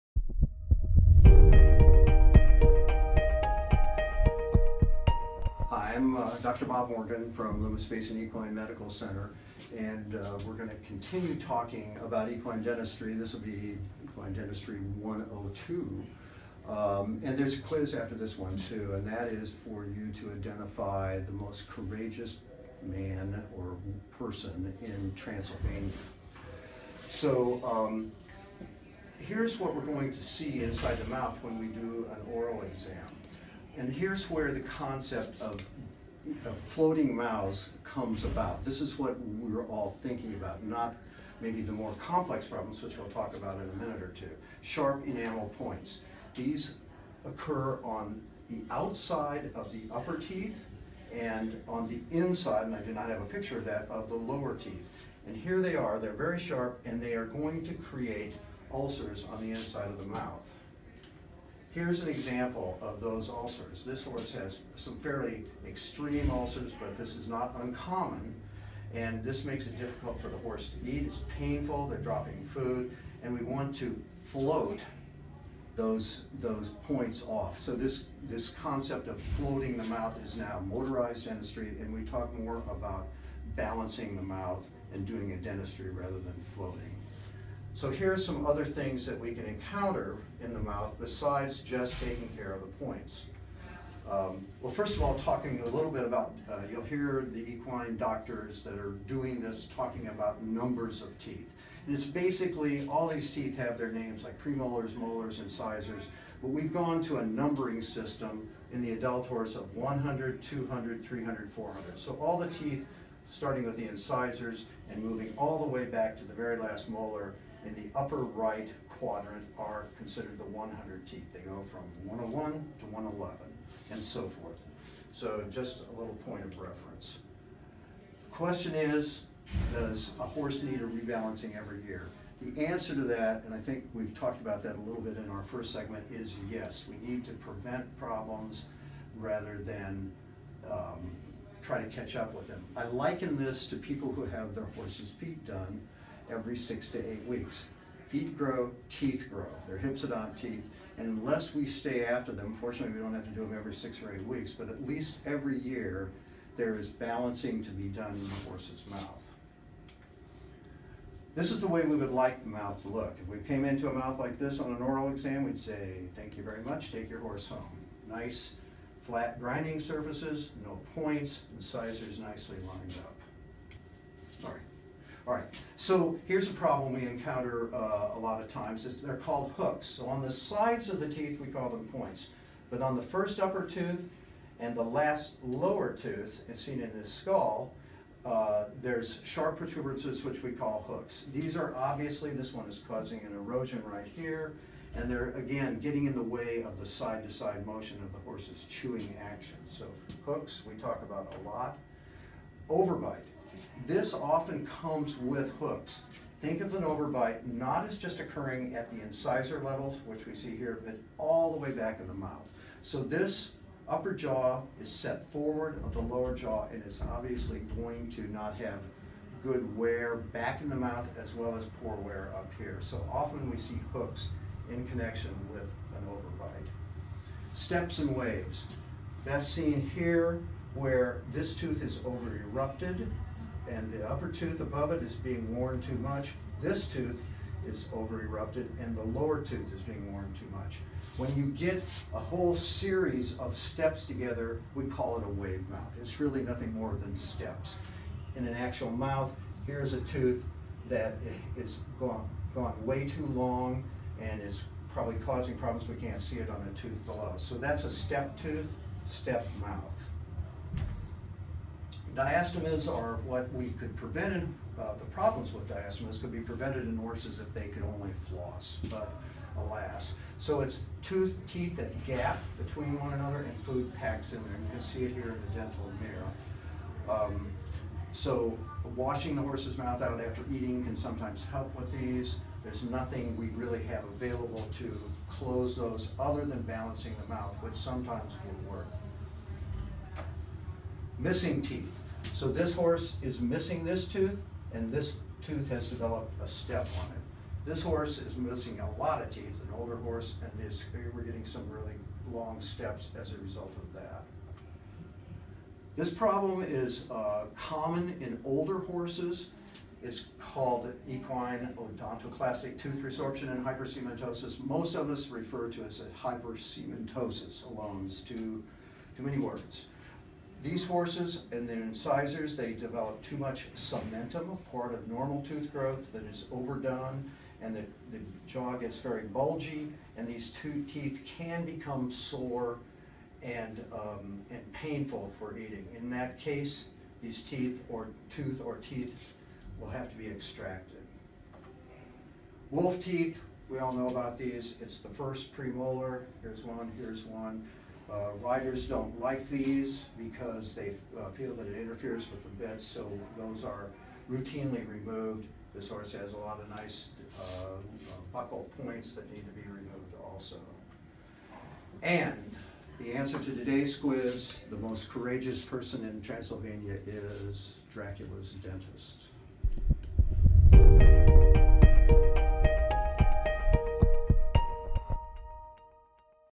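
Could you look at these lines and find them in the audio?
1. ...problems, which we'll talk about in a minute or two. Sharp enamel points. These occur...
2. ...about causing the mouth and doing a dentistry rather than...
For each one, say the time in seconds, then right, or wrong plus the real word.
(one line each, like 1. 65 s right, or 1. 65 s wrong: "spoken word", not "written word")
1. 42 s right
2. 82 s wrong: "balancing", not "causing".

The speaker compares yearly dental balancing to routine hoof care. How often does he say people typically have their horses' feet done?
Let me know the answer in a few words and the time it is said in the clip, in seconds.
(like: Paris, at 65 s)
every 6 to 8 weeks, at 146 s.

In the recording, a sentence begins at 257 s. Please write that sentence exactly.
So that's a step tooth, step mouth.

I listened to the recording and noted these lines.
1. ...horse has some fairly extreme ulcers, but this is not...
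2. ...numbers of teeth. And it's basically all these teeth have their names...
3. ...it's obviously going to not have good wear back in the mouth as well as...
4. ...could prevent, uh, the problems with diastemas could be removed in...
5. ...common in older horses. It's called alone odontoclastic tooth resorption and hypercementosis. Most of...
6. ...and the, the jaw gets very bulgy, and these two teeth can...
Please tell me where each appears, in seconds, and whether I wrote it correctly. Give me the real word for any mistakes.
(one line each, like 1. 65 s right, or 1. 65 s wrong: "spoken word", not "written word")
1. 64 s right
2. 100 s right
3. 216 s right
4. 263 s wrong: "prevented", not "removed"
5. 307 s wrong: "equine", not "alone"
6. 327 s right.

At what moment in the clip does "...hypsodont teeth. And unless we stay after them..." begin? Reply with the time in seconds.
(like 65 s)
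149 s.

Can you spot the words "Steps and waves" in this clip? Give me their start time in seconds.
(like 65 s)
227 s.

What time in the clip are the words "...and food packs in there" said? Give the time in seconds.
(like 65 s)
273 s.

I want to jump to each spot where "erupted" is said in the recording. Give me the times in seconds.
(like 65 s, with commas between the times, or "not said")
232 s, 238 s.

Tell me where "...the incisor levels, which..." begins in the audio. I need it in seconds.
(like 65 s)
208 s.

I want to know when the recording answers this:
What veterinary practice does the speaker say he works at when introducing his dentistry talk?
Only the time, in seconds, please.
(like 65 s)
7 s.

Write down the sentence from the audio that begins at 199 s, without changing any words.
So hooks, we talk about a lot.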